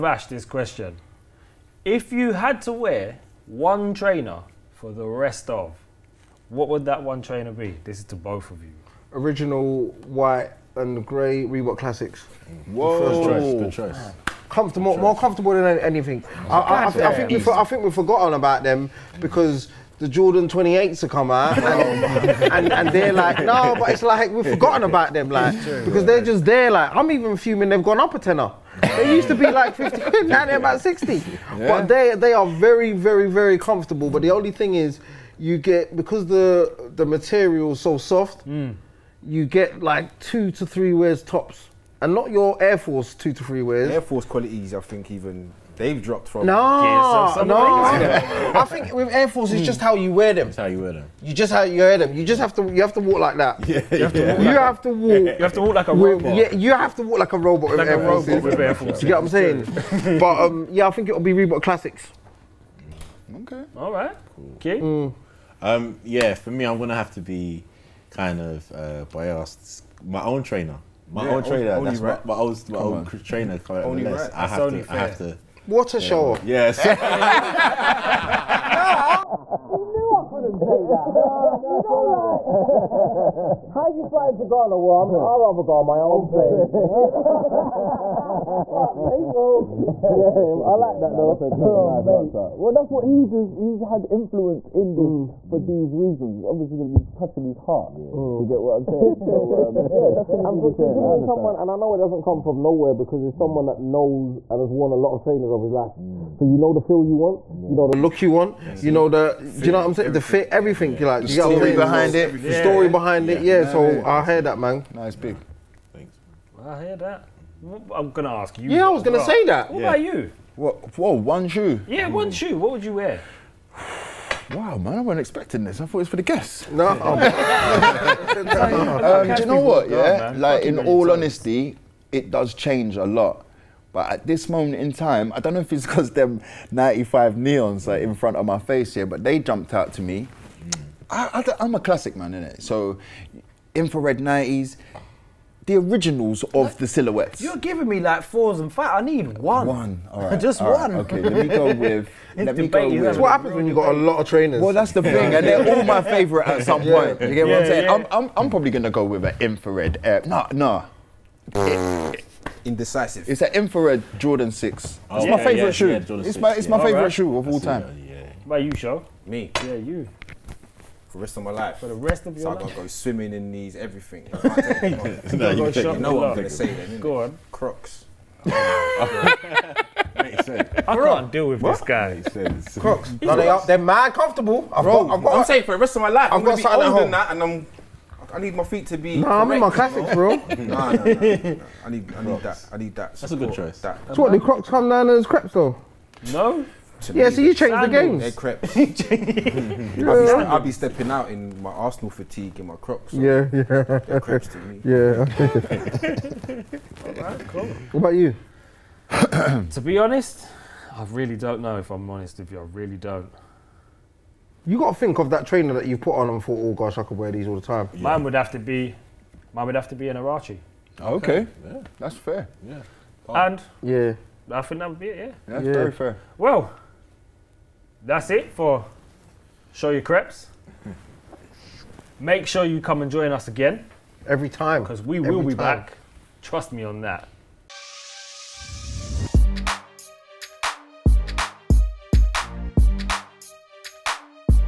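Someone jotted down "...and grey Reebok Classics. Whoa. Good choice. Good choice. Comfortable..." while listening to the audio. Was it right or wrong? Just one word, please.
right.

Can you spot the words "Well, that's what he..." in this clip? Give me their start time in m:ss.
1:32.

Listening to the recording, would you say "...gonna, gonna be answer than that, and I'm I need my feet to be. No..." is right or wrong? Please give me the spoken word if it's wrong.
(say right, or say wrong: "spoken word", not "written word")
wrong: "older", not "answer".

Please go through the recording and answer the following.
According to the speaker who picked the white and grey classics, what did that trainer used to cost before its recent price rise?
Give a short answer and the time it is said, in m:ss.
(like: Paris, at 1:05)
£50, at 0:29.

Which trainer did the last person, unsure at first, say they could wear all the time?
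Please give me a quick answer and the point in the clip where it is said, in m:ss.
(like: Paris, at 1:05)
Huarache, at 3:40.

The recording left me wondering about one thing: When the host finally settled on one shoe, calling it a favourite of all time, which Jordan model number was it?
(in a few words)
Jordan 6.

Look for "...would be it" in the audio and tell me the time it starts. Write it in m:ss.
3:44.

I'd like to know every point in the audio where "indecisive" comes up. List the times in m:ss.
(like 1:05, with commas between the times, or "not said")
2:42.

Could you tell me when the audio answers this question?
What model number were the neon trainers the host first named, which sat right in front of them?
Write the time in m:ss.
2:16.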